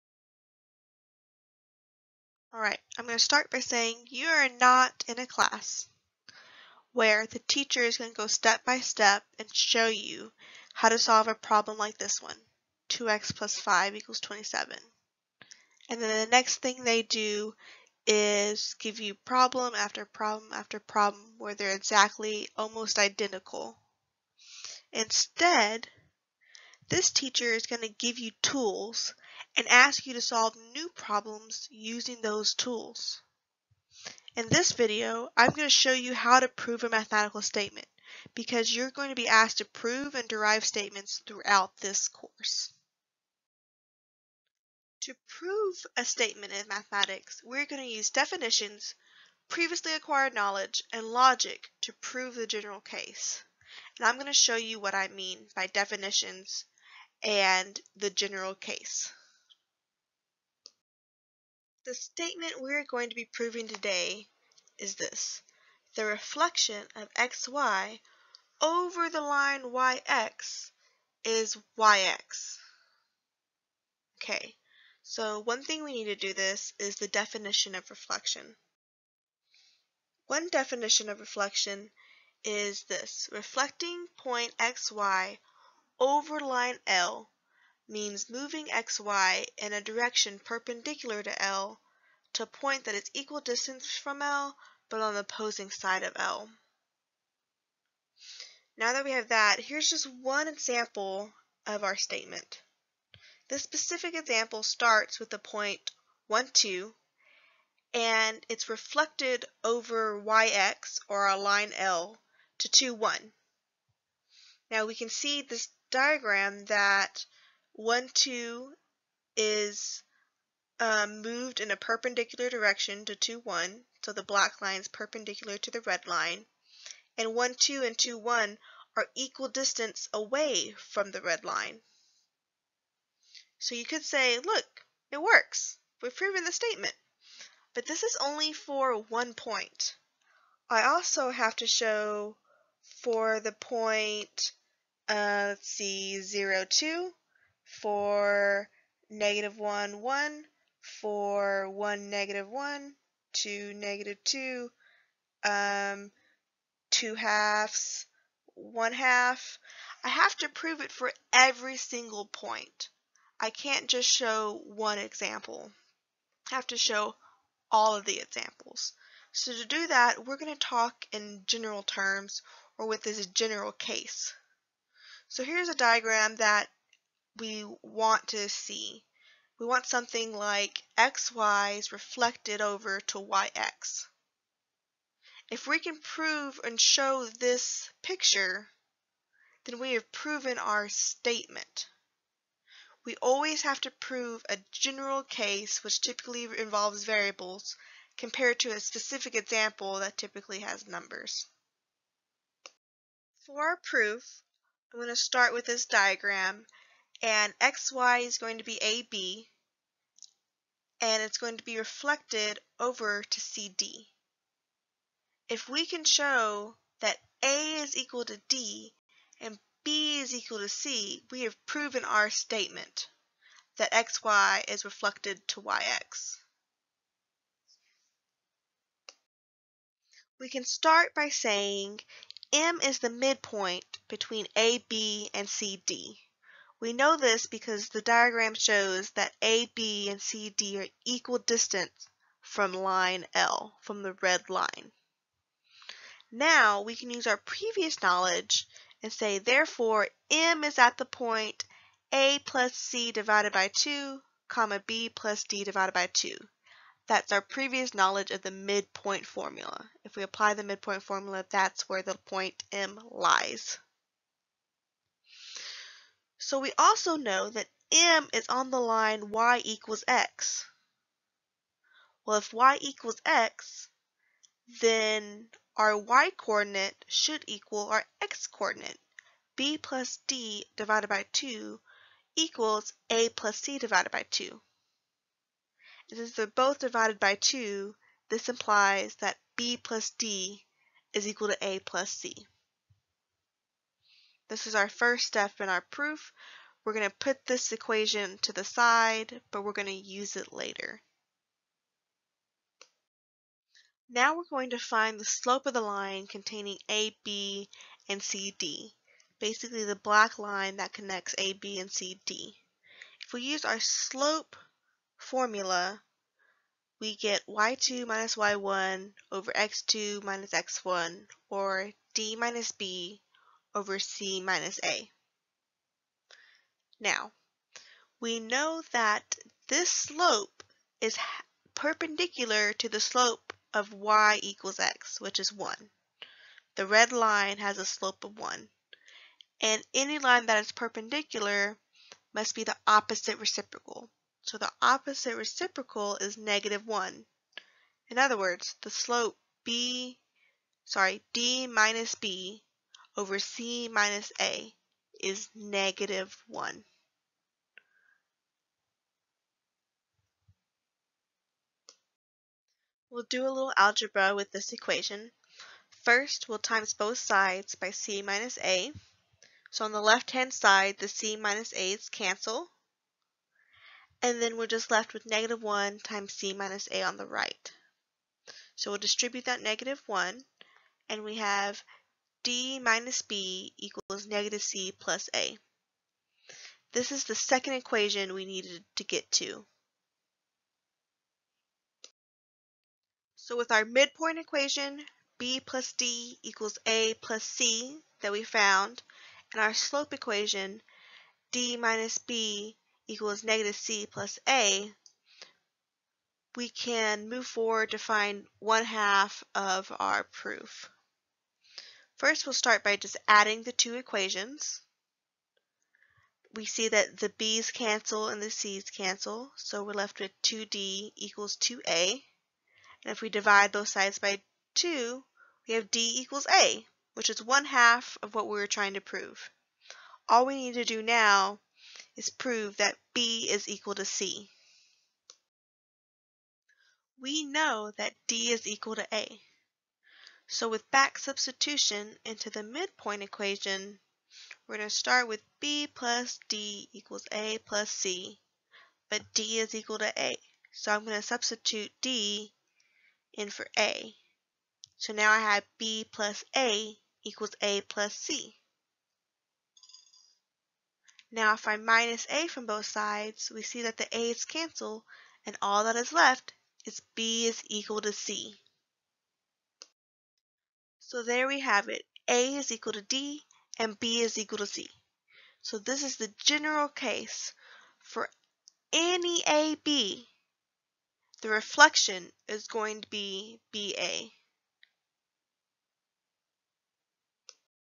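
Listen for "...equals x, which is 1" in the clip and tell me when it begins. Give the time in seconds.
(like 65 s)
334 s.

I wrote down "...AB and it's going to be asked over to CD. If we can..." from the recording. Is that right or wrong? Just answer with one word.
wrong.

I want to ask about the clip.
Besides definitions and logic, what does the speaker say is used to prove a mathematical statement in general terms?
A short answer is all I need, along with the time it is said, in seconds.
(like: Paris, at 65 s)
previously acquired knowledge, at 49 s.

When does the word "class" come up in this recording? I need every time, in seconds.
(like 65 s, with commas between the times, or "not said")
5 s.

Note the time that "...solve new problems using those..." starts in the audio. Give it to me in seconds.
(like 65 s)
30 s.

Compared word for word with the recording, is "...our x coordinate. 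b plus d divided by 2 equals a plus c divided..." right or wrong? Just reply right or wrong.
right.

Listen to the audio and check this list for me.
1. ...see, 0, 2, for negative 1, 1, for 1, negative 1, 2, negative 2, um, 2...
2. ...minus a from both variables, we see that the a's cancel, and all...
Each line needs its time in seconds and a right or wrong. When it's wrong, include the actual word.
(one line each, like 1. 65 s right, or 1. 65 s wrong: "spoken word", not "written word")
1. 145 s right
2. 461 s wrong: "sides", not "variables".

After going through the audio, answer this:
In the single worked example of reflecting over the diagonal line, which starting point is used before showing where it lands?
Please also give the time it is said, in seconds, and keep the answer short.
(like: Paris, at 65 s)
(1, 2), at 105 s.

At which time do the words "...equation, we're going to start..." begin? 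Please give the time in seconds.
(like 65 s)
443 s.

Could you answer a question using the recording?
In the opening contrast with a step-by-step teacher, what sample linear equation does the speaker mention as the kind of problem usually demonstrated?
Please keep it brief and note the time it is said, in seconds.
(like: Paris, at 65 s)
2x + 5 = 27, at 12 s.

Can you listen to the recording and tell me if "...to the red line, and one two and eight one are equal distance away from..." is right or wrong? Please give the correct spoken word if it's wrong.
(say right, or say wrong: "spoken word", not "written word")
wrong: "two", not "eight".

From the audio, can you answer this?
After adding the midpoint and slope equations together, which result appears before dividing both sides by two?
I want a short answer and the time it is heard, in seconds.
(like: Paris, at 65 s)
2d = 2a, at 420 s.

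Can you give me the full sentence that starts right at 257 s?
That's our previous knowledge of the midpoint formula.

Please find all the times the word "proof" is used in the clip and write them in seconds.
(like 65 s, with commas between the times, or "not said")
203 s, 295 s, 410 s.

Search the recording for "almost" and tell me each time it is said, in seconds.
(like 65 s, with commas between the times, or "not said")
22 s.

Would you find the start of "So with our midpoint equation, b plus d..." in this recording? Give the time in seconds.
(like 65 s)
393 s.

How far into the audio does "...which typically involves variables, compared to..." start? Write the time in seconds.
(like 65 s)
195 s.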